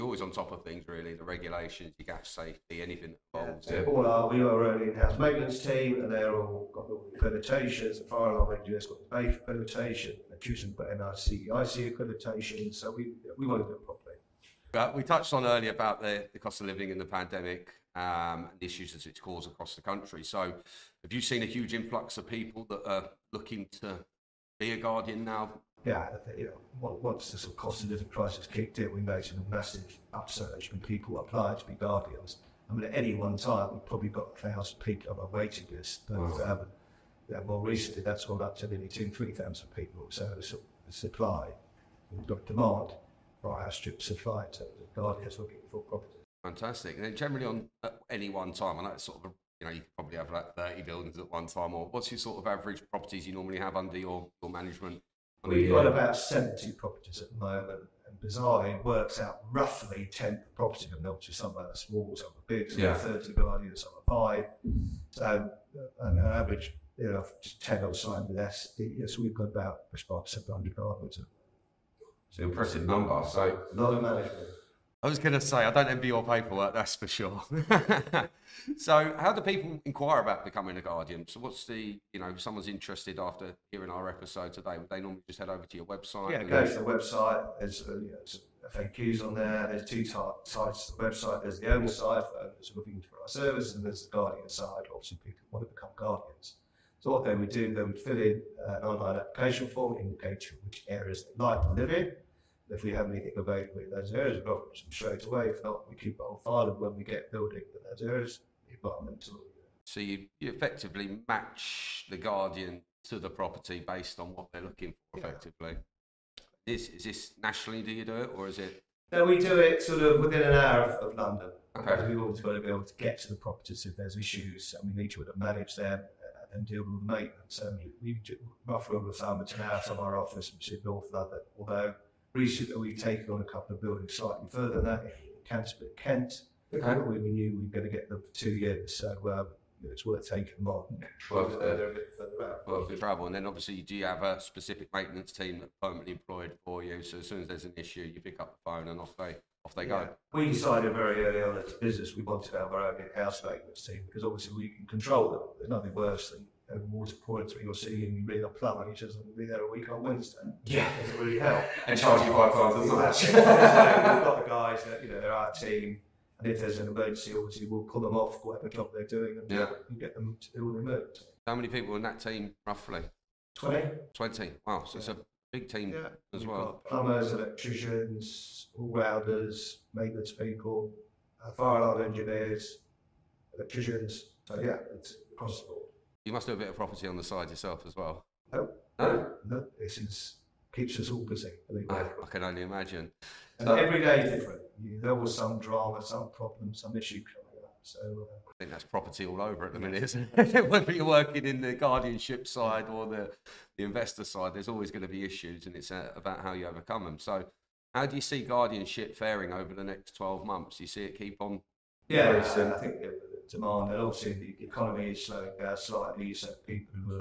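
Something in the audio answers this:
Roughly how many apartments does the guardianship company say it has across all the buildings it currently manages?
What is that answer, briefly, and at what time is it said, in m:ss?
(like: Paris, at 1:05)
700, at 1:10.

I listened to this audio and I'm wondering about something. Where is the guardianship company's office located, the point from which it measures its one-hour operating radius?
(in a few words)
North London.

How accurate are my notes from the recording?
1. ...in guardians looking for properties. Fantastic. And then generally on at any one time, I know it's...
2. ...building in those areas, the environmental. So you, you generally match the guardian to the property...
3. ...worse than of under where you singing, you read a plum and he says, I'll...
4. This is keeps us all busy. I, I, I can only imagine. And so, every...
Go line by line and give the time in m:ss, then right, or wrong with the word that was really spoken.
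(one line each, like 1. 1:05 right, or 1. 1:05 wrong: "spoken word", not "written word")
1. 0:44 right
2. 1:47 wrong: "effectively", not "generally"
3. 2:35 wrong: "water", not "under"
4. 3:09 right.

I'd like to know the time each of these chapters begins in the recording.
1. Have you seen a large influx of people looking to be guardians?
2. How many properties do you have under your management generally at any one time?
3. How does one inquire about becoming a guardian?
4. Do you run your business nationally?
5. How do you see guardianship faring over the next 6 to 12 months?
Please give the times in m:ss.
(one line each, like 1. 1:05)
1. 0:15
2. 0:47
3. 1:15
4. 1:55
5. 3:28.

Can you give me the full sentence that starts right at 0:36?
But um, yeah, more recently, that's gone up to nearly two, three thousand people.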